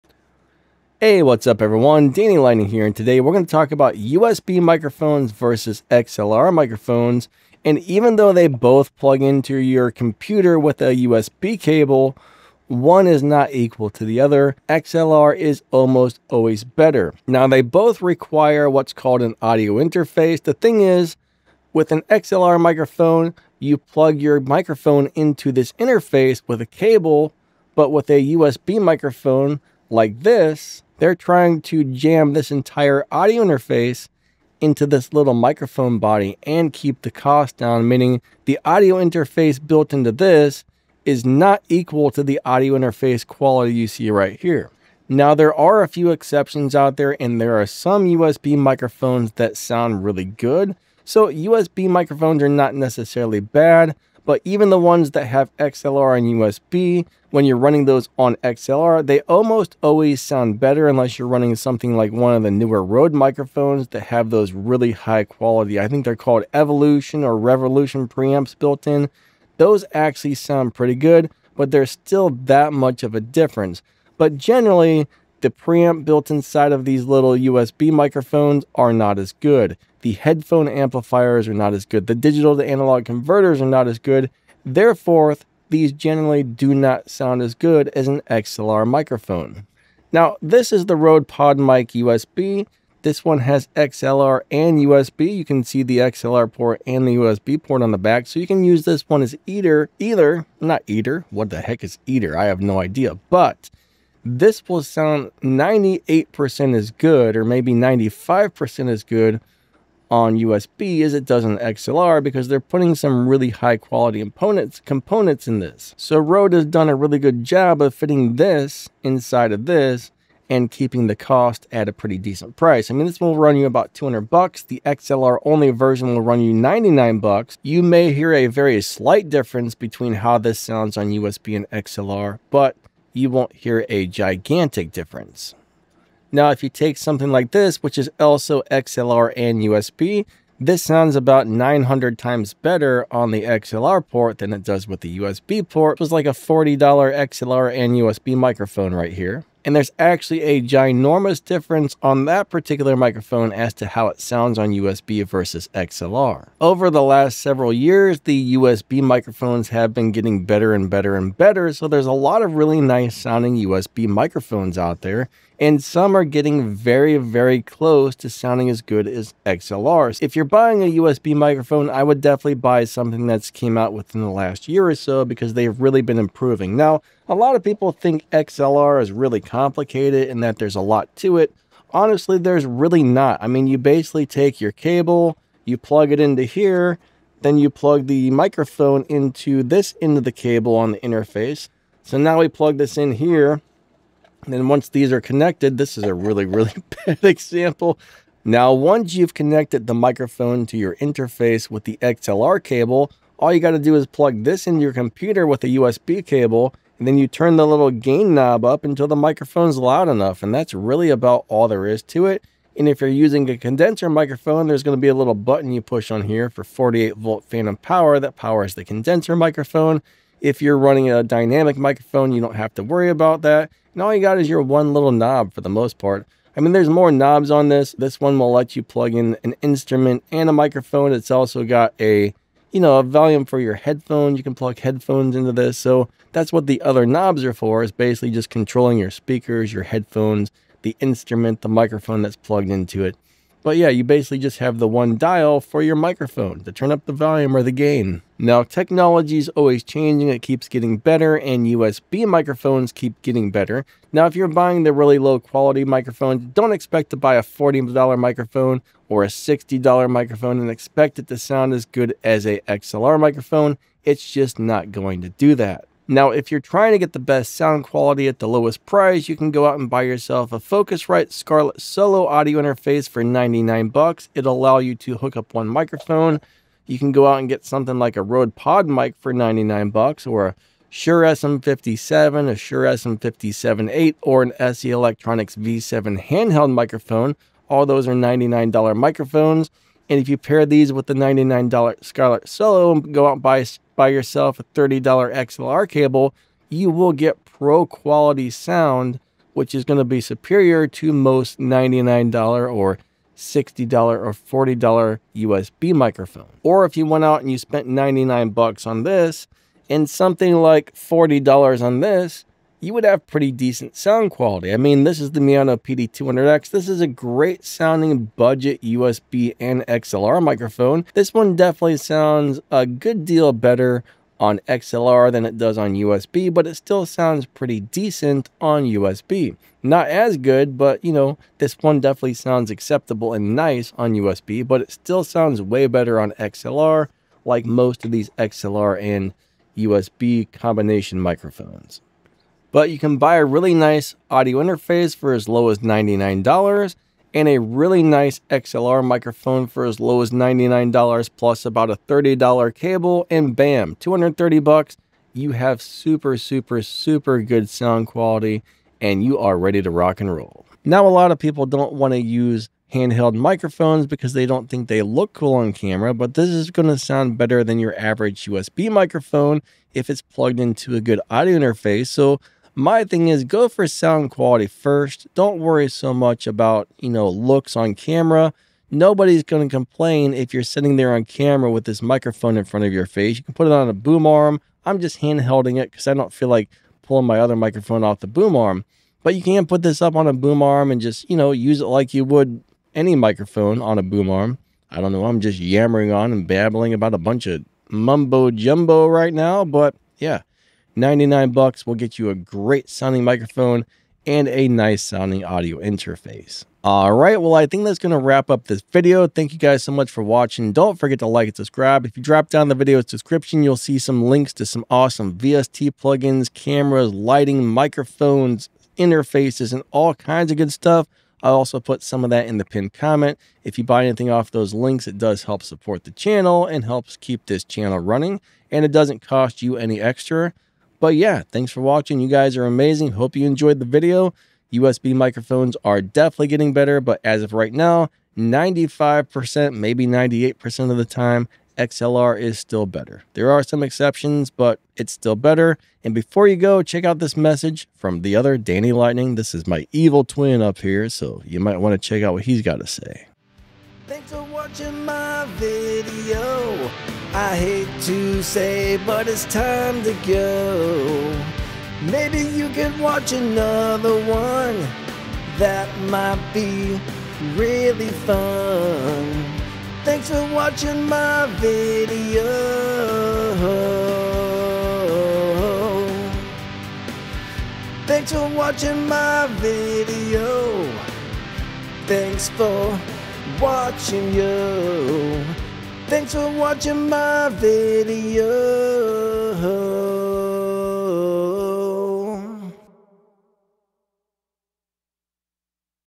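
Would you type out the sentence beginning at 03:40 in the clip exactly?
If you're running a dynamic microphone, you don't have to worry about that.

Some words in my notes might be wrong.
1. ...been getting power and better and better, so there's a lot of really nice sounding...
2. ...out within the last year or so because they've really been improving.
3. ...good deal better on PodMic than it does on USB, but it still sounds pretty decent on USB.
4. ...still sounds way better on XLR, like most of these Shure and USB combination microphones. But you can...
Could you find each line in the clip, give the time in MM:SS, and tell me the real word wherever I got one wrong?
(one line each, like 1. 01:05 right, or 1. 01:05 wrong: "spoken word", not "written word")
1. 02:39 wrong: "better", not "power"
2. 02:53 right
3. 05:22 wrong: "XLR", not "PodMic"
4. 05:34 wrong: "XLR", not "Shure".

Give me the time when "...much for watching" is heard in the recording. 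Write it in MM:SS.
06:49.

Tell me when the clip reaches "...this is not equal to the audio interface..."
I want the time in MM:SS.
00:40.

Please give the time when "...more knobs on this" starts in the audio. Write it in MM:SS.
03:46.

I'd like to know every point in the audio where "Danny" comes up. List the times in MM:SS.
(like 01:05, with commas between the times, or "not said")
00:02, 07:28.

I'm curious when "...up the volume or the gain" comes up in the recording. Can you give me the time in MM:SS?
04:06.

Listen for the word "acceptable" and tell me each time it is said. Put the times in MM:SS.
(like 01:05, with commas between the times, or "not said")
05:32.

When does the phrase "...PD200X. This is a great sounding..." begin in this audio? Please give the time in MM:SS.
05:15.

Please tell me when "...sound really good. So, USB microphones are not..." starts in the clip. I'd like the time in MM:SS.
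00:49.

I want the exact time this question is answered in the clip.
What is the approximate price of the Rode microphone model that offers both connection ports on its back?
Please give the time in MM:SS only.
02:03.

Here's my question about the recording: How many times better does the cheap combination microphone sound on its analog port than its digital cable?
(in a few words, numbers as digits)
900.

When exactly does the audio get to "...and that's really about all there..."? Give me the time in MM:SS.
03:30.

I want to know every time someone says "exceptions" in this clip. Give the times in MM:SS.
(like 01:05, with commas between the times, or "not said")
00:46, 07:23.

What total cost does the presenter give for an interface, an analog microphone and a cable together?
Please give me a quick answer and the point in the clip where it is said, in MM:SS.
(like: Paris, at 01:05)
$230, at 05:53.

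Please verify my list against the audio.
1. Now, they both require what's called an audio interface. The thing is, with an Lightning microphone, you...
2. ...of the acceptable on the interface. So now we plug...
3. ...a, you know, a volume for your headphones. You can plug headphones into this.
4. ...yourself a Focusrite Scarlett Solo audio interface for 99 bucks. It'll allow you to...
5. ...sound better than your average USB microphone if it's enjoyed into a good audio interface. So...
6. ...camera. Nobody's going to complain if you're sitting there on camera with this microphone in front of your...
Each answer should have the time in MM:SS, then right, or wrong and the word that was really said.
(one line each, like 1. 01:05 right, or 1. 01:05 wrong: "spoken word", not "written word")
1. 00:17 wrong: "XLR", not "Lightning"
2. 03:10 wrong: "cable", not "acceptable"
3. 03:51 right
4. 04:30 right
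5. 06:06 wrong: "plugged", not "enjoyed"
6. 06:17 right.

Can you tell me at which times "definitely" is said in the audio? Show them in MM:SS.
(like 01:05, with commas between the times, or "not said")
02:52, 05:21, 05:31, 07:15.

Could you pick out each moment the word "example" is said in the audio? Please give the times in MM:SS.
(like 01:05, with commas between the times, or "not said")
03:17.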